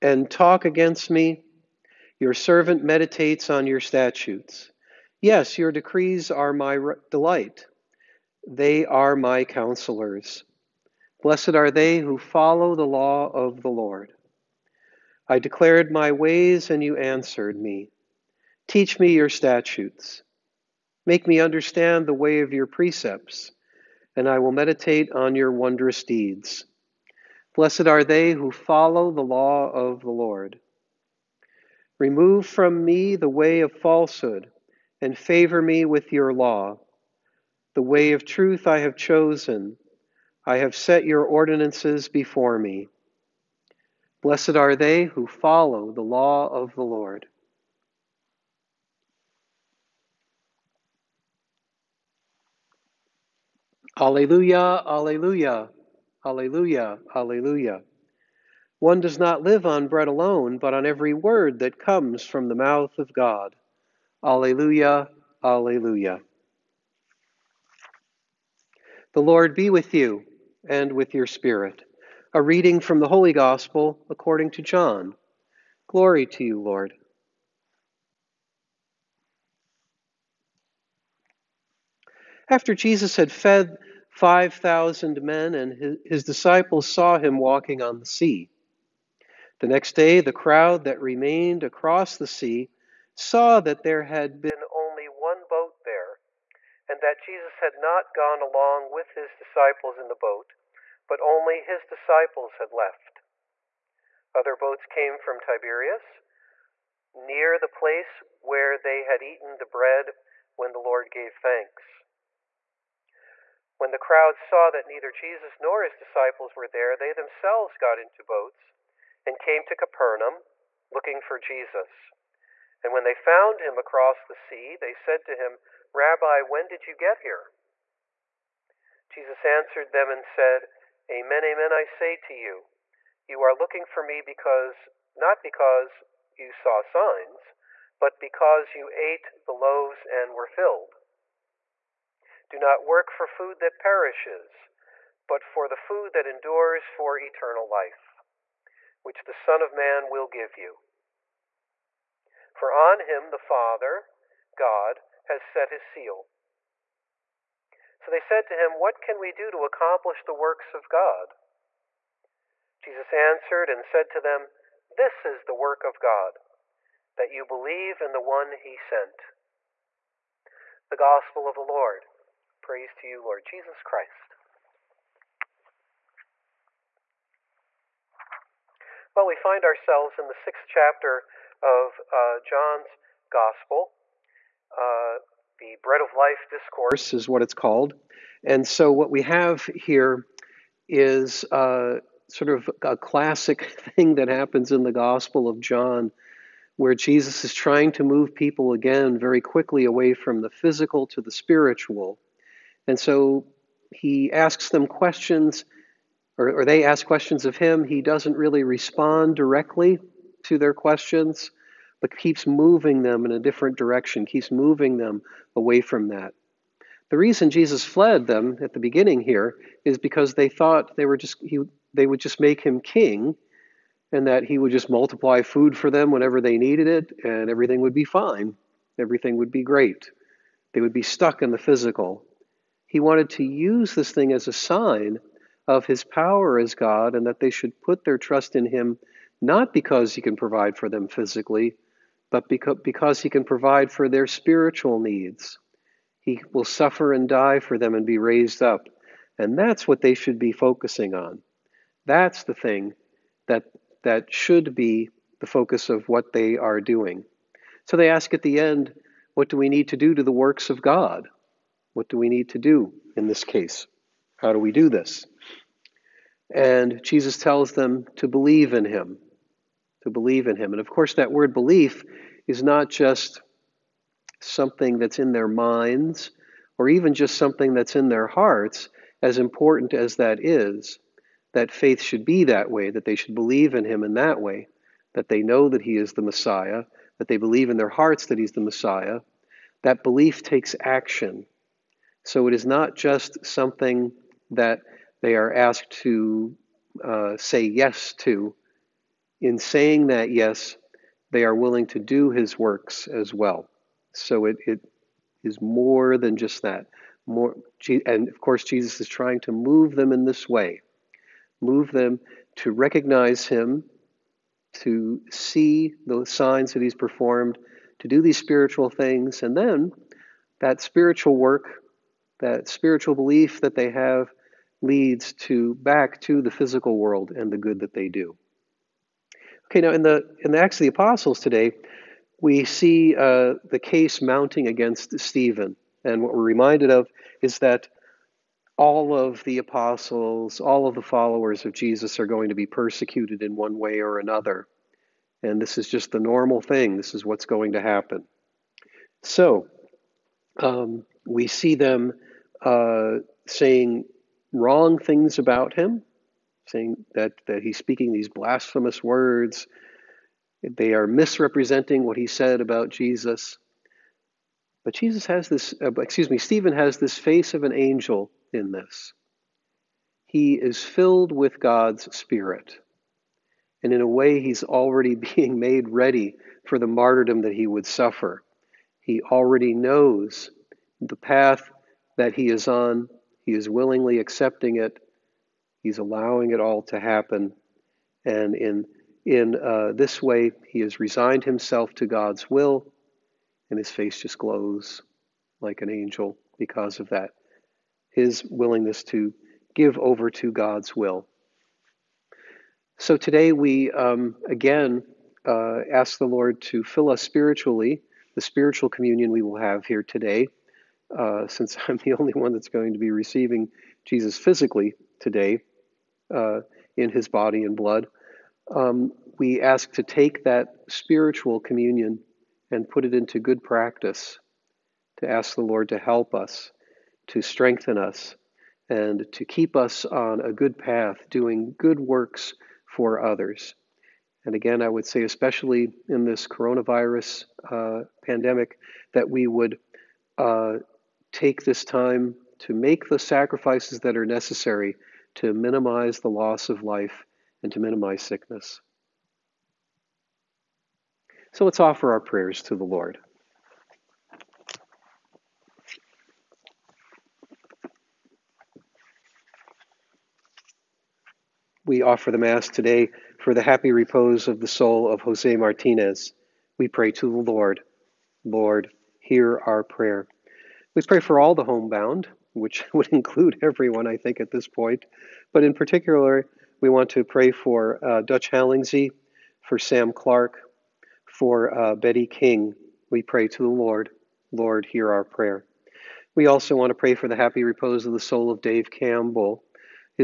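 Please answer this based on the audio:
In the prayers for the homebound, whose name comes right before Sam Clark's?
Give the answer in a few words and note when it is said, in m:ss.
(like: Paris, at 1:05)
Dutch Hallingsey, at 7:58.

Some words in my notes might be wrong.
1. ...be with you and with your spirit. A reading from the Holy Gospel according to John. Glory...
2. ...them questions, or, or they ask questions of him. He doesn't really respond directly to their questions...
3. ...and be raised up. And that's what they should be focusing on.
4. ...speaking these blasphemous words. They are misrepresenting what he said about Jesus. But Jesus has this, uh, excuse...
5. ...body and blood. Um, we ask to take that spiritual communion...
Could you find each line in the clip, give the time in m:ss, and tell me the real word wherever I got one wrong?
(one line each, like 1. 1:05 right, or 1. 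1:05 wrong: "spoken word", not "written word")
1. 1:09 right
2. 3:24 right
3. 4:07 right
4. 5:57 right
5. 6:57 right.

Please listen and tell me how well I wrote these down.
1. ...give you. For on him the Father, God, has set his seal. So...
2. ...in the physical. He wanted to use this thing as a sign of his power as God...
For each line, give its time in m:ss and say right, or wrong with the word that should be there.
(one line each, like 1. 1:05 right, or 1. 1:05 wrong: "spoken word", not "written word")
1. 2:30 right
2. 3:51 right.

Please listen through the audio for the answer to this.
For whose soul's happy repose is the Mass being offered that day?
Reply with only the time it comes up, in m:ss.
7:45.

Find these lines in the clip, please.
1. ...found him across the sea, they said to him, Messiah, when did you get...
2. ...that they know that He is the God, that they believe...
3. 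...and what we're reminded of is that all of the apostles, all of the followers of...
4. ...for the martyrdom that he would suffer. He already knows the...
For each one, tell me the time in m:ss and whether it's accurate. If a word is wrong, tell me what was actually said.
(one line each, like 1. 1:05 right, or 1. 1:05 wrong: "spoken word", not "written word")
1. 2:03 wrong: "Rabbi", not "Messiah"
2. 4:45 wrong: "Messiah", not "God"
3. 5:36 right
4. 6:16 right.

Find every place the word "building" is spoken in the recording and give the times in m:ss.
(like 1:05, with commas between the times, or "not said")
not said.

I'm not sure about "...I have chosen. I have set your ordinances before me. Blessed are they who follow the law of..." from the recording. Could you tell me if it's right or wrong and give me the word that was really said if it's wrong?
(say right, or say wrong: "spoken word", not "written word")
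right.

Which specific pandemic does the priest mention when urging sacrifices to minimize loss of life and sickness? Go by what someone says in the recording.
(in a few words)
coronavirus.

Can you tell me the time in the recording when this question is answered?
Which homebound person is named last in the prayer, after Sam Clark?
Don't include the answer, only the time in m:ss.
8:01.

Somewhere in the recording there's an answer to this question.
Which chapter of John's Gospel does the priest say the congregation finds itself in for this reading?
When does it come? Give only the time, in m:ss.
3:00.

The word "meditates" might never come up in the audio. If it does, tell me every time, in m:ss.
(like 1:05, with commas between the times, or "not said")
0:02, 0:24.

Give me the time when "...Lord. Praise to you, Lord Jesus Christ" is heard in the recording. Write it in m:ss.
2:51.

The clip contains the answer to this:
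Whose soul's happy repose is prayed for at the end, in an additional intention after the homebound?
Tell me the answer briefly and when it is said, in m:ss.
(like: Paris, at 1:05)
Dave Campbell, at 8:08.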